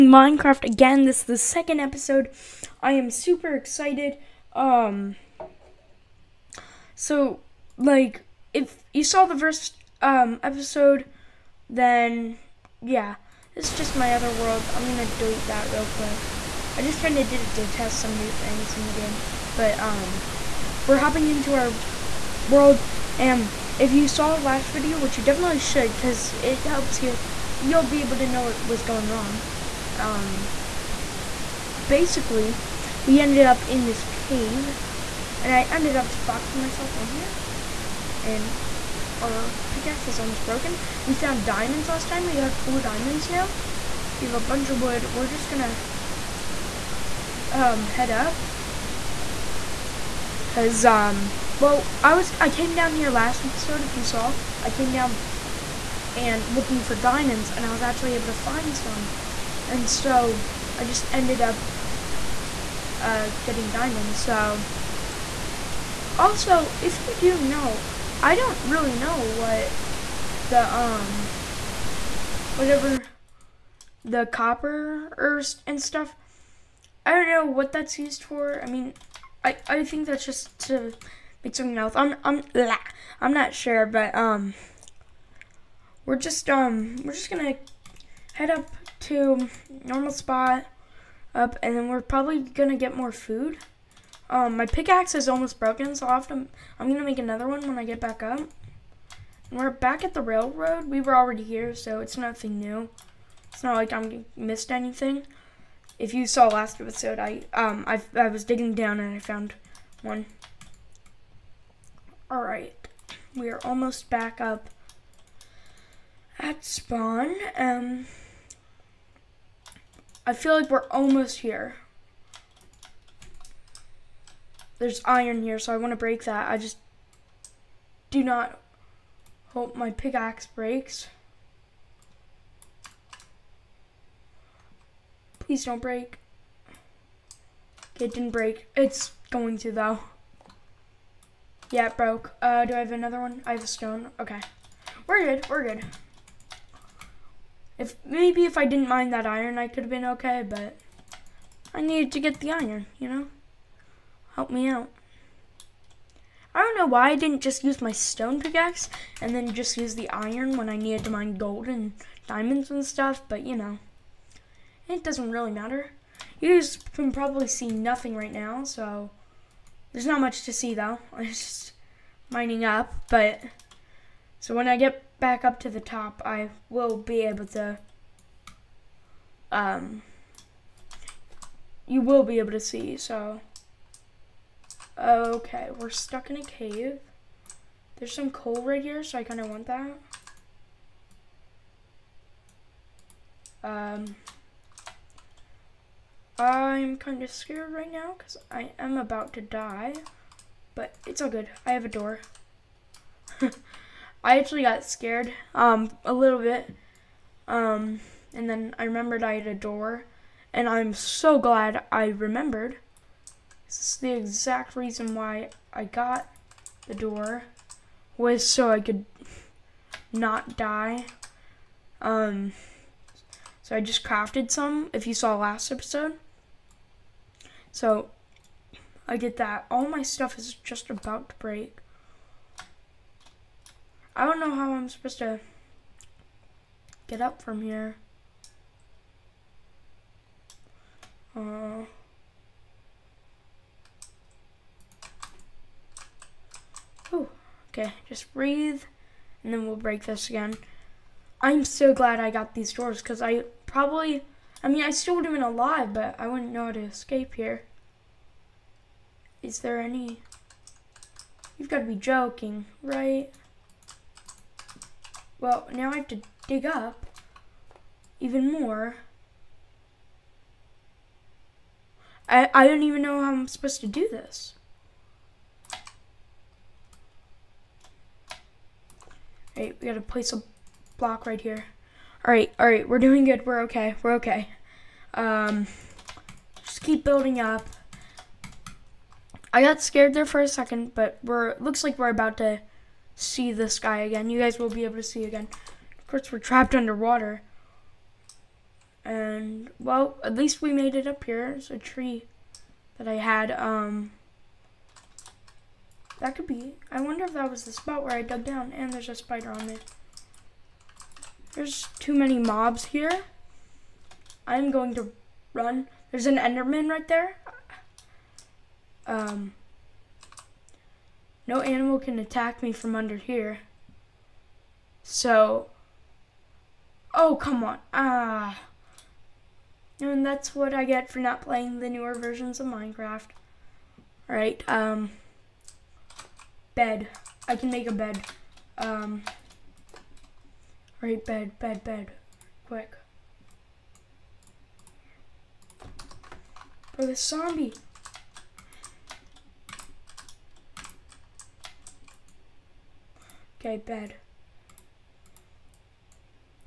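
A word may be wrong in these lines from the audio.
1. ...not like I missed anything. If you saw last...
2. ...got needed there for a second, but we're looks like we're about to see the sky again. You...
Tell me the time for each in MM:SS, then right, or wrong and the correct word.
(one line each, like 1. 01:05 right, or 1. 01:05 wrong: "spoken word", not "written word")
1. 01:43 right
2. 04:49 wrong: "scared", not "needed".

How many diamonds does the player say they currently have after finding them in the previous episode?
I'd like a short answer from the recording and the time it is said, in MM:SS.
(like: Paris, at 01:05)
4, at 00:42.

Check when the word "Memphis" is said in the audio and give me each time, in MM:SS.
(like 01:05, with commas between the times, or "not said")
not said.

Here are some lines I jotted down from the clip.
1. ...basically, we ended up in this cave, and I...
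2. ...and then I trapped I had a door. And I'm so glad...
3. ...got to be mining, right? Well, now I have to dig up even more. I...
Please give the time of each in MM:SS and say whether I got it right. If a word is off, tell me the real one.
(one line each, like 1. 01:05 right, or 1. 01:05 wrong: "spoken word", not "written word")
1. 00:31 right
2. 03:28 wrong: "remembered", not "trapped"
3. 04:21 wrong: "joking", not "mining".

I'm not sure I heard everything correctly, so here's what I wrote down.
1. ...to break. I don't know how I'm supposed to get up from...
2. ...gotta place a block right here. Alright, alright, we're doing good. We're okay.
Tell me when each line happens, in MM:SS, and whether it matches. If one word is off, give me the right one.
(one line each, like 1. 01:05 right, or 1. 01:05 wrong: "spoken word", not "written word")
1. 03:51 right
2. 04:39 right.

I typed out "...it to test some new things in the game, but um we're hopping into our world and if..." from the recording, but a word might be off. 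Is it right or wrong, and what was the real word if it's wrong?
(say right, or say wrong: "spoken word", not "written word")
right.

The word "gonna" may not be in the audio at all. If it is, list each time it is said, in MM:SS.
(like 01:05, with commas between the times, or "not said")
00:45, 01:27, 01:32, 01:36.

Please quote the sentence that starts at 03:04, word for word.
Okay, we're stuck in a cave.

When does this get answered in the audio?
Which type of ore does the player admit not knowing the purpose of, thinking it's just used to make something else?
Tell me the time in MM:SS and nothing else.
01:14.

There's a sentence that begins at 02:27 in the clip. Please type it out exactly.
If Maybe if I didn't mind that iron, I could have been okay, but I needed to get the iron, you know?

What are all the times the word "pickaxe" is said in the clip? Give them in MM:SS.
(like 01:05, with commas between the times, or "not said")
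00:39, 01:34, 02:09, 02:38.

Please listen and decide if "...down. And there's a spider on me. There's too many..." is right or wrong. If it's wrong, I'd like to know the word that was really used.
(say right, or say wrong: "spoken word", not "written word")
right.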